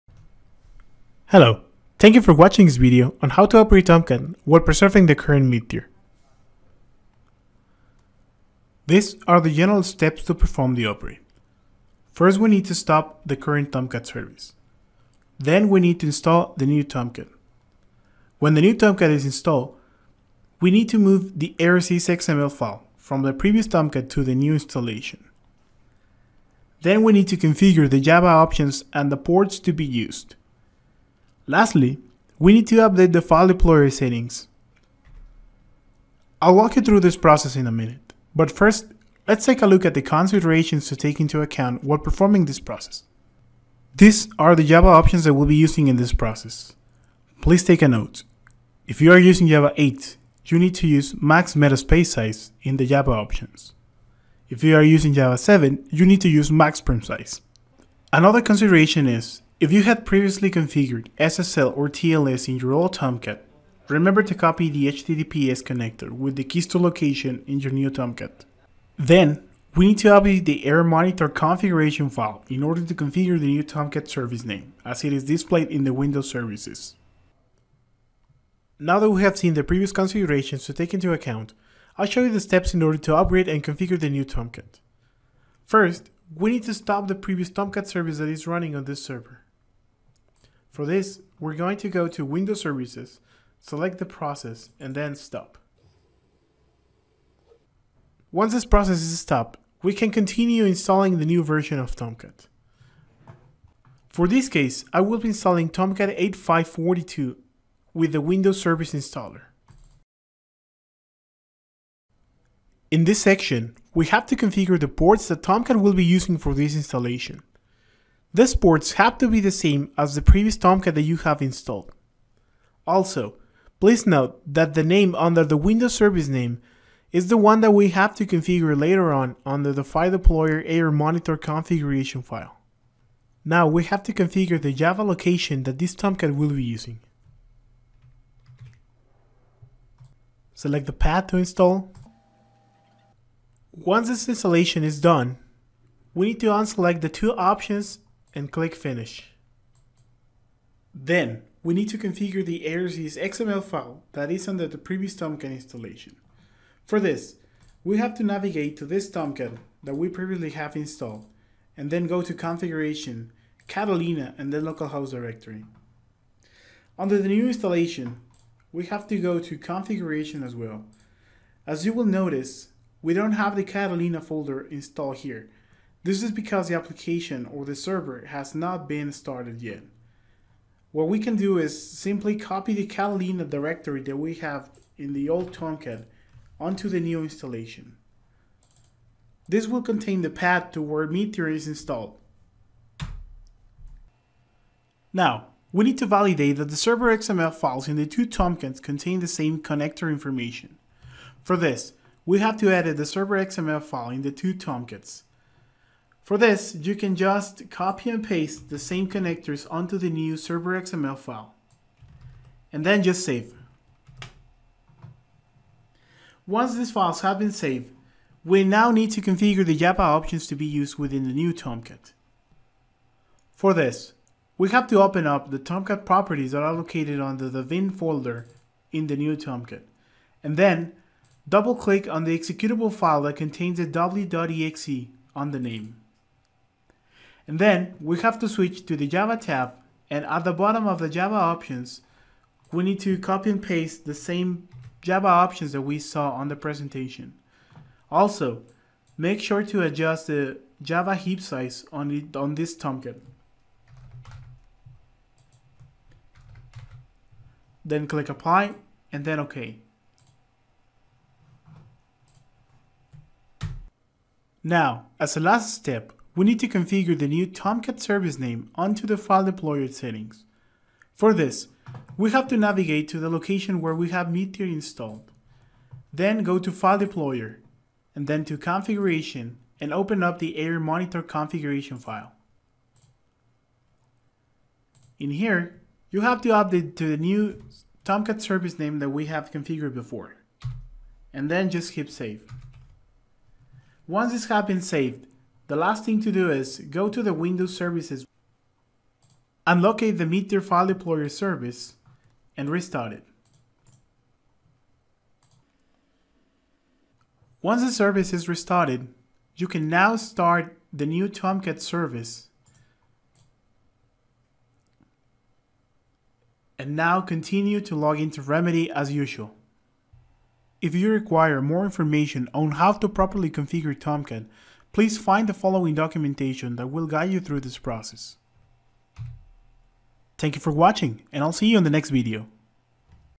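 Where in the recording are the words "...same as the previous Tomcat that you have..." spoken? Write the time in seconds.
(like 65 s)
119 s.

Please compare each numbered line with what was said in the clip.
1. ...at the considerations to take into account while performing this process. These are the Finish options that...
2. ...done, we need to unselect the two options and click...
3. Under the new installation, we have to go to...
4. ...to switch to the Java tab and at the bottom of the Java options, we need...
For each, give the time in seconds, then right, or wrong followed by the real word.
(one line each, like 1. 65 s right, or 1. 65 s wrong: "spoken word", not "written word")
1. 39 s wrong: "Java", not "Finish"
2. 145 s right
3. 166 s right
4. 238 s right.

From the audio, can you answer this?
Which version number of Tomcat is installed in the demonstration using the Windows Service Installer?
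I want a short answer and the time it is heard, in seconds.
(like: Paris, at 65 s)
8542, at 106 s.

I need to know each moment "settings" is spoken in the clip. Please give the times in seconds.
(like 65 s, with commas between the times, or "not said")
33 s, 269 s.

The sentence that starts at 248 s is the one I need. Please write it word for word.
Also, make sure to adjust the Java heap size on, it, on this Tomcat.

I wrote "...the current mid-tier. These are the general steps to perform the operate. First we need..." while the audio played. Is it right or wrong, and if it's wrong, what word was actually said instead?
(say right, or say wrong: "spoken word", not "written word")
right.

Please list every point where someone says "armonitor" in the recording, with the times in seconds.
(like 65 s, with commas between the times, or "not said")
70 s, 130 s, 280 s.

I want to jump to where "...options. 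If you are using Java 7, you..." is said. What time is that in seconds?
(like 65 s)
53 s.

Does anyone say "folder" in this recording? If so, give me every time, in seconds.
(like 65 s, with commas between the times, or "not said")
174 s, 227 s.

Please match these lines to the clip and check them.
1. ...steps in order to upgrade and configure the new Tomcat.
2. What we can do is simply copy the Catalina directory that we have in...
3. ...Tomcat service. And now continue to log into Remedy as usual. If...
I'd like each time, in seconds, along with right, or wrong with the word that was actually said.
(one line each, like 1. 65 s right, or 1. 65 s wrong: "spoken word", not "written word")
1. 82 s right
2. 180 s right
3. 311 s right.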